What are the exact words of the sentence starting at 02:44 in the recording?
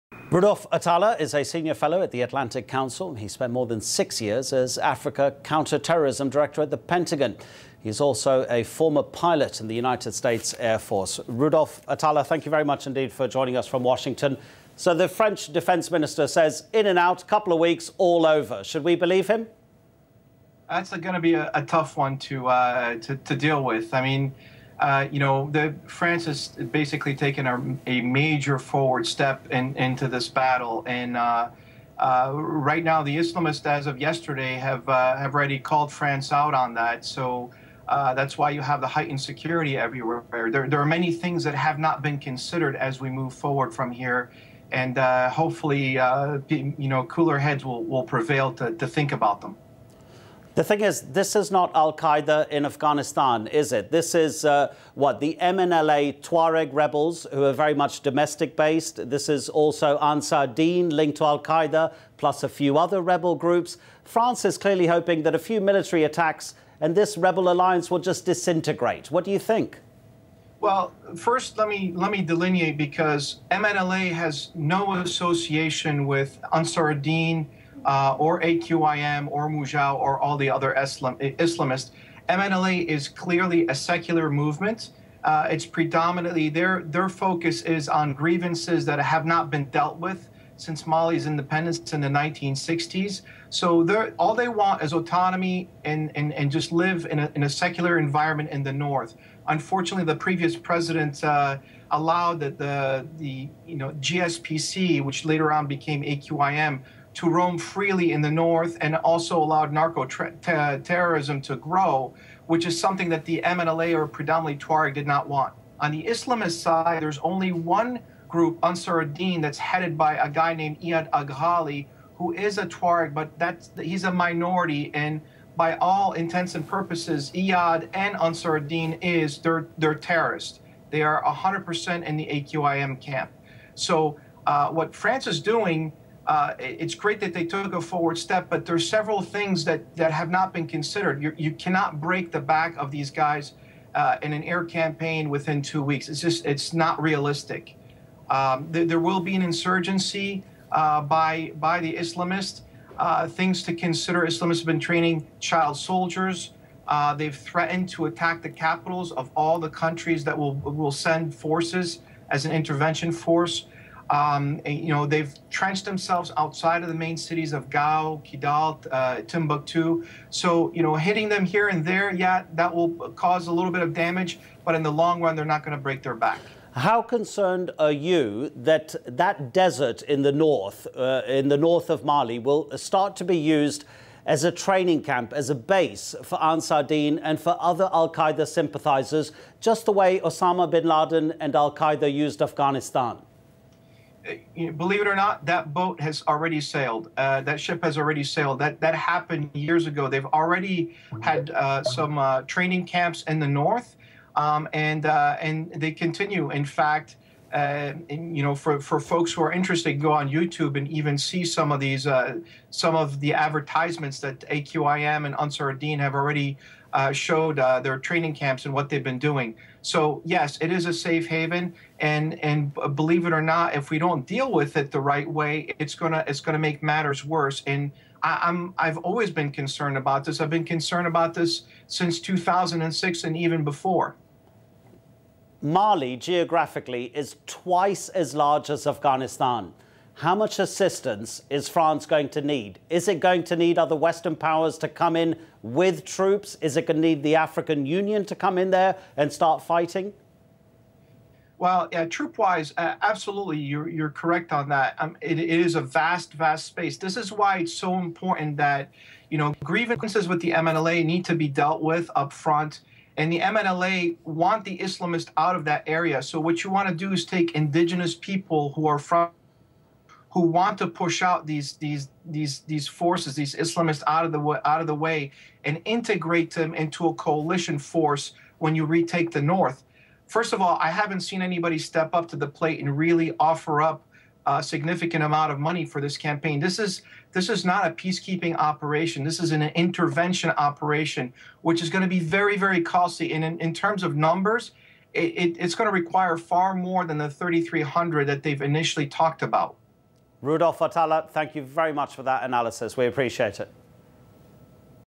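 Um, and, you know, they've trenched themselves outside of the main cities of Gao, Kidal, uh, Timbuktu.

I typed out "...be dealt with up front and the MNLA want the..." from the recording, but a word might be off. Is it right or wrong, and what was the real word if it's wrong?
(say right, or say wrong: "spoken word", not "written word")
right.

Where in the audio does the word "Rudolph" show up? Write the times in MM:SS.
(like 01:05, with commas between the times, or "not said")
00:00, 00:11, 05:00.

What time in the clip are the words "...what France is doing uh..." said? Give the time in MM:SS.
02:14.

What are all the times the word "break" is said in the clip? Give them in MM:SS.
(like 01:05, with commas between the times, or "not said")
02:21, 02:55.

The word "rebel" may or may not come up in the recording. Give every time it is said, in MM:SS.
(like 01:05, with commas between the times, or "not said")
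00:56, 01:03, 01:07.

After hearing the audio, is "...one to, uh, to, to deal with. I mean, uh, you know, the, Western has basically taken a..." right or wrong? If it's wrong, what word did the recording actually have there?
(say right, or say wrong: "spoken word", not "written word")
wrong: "France", not "Western".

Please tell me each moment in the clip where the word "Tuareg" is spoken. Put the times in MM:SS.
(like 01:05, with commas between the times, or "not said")
00:56, 01:54, 02:02.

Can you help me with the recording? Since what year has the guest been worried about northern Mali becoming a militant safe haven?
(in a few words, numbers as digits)
2006.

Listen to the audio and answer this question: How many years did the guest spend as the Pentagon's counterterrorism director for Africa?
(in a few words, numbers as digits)
more than 6 years.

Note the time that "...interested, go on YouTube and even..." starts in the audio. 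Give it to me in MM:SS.
03:29.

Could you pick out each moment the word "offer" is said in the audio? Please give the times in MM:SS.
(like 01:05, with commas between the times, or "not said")
04:43.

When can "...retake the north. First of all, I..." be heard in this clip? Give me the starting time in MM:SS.
04:38.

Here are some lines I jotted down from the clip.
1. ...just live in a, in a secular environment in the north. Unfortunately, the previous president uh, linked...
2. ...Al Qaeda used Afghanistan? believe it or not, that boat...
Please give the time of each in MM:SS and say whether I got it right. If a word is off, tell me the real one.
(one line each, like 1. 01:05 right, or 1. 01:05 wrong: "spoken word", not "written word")
1. 01:36 wrong: "allowed", not "linked"
2. 03:11 right.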